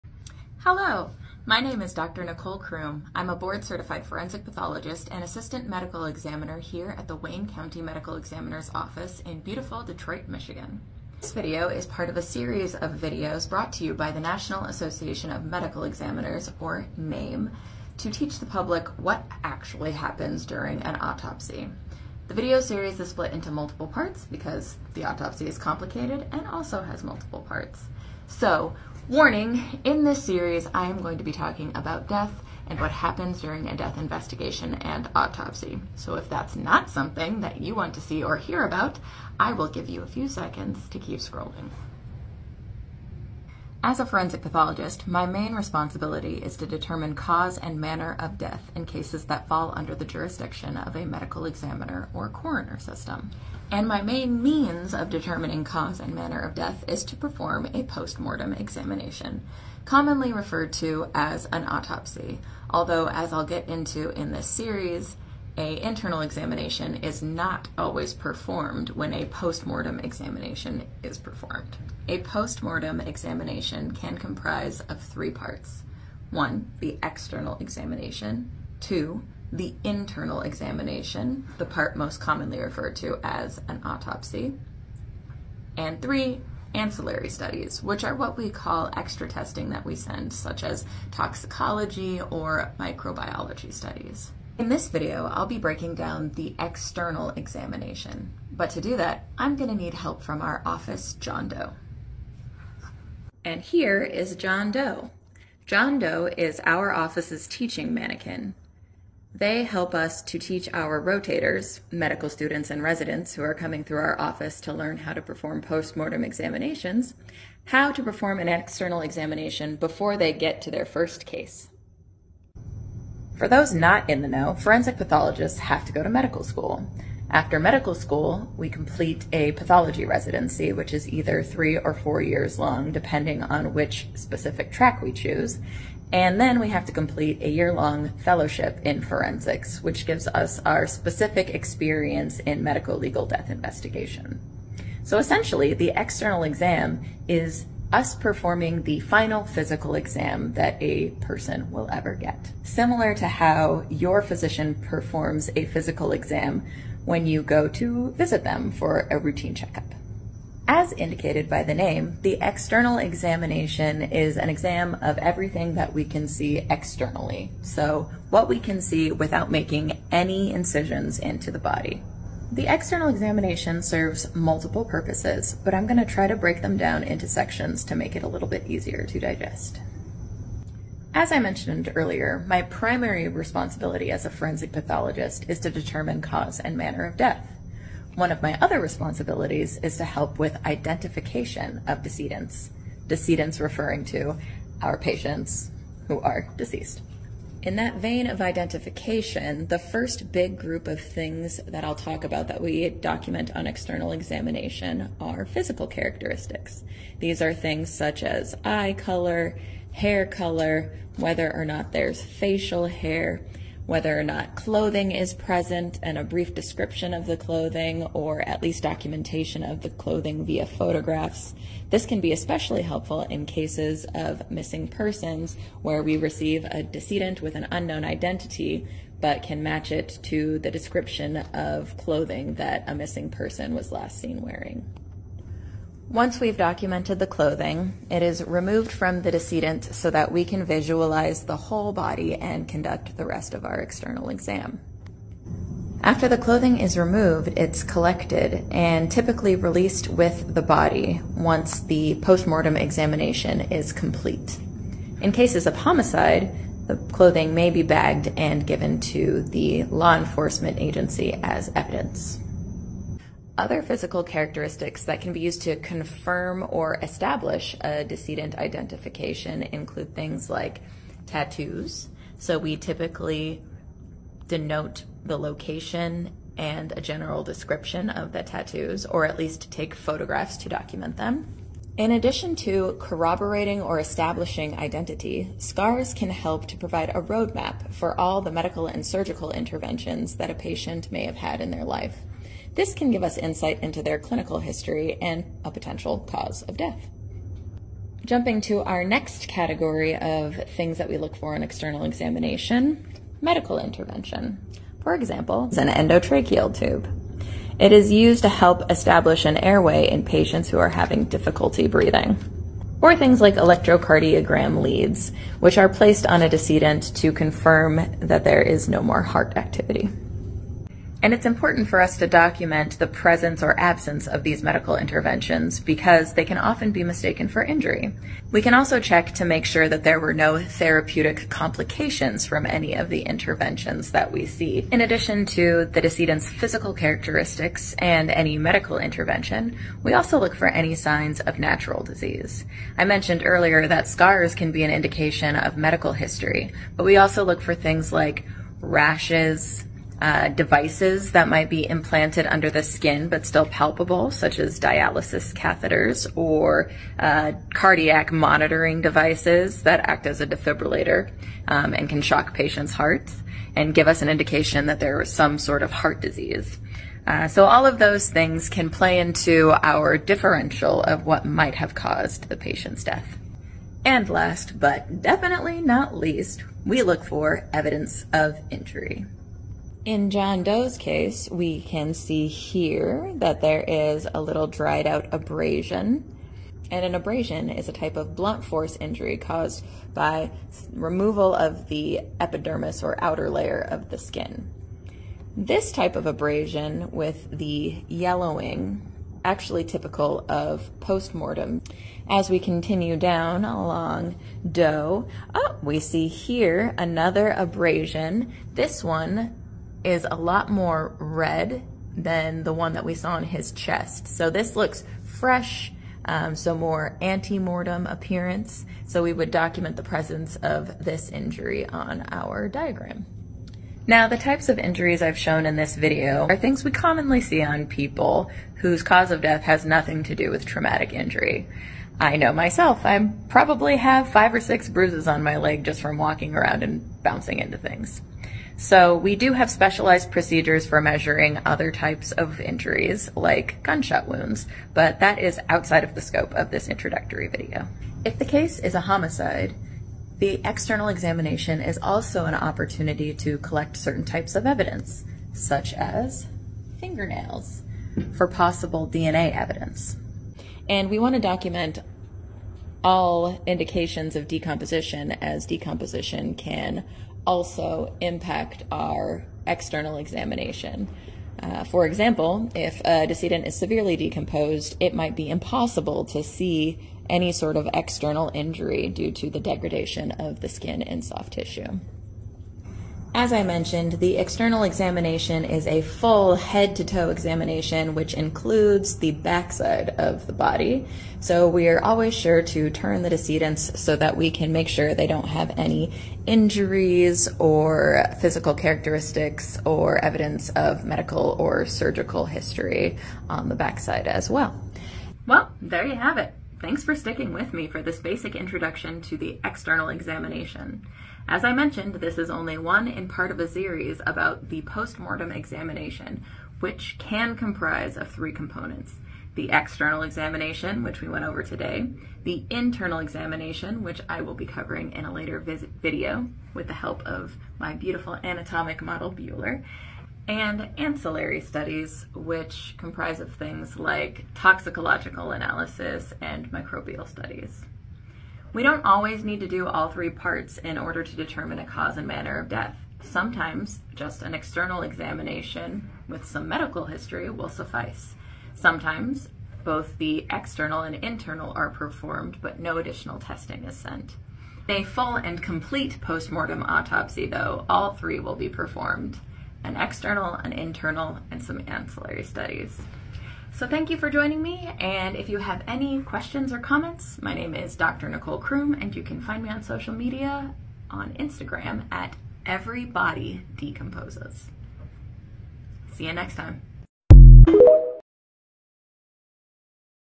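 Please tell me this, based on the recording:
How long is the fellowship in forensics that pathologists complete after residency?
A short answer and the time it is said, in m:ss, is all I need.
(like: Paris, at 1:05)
1 year, at 2:17.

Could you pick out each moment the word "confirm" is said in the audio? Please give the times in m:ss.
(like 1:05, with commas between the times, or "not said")
4:25, 5:17.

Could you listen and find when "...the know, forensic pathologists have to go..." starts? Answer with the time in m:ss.
2:04.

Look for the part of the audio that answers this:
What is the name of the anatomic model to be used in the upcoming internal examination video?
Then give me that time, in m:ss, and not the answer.
8:49.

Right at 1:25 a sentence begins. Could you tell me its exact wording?
And three, ancillary studies, which are what we call extra testing that we send, such as toxicology or microbiology studies.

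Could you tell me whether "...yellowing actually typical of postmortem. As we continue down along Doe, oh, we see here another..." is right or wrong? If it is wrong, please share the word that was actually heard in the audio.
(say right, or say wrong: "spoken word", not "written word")
right.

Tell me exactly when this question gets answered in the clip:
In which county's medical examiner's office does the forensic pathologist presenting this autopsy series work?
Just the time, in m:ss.
0:07.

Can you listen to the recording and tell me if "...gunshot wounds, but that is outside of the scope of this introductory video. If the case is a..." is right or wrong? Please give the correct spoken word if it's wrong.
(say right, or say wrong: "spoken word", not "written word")
right.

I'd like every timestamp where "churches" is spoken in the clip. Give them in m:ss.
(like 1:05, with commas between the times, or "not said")
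not said.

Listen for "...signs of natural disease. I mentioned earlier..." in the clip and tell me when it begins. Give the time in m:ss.
5:40.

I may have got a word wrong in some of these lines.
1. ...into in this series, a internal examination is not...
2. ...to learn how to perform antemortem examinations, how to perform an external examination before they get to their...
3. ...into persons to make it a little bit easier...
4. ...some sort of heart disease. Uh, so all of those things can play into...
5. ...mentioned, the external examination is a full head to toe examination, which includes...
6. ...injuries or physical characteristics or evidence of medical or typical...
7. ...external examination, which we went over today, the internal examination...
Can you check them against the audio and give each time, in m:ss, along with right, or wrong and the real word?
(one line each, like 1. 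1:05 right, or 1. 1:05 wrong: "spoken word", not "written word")
1. 1:03 right
2. 1:54 wrong: "postmortem", not "antemortem"
3. 2:57 wrong: "sections", not "persons"
4. 6:05 right
5. 8:03 right
6. 8:16 wrong: "surgical", not "typical"
7. 8:39 right.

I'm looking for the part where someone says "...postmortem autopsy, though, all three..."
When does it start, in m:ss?
9:16.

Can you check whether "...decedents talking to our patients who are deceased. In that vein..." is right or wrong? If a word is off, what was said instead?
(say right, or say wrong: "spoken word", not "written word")
wrong: "referring", not "talking".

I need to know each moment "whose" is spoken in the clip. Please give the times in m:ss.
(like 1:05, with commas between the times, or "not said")
7:08.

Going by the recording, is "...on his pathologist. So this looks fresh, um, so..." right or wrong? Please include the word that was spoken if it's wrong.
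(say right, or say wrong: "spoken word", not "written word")
wrong: "chest", not "pathologist".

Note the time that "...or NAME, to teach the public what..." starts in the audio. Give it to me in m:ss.
0:16.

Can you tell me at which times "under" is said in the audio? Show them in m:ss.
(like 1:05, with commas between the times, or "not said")
0:49, 5:52.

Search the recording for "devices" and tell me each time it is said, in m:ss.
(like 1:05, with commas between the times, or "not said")
5:50, 5:59.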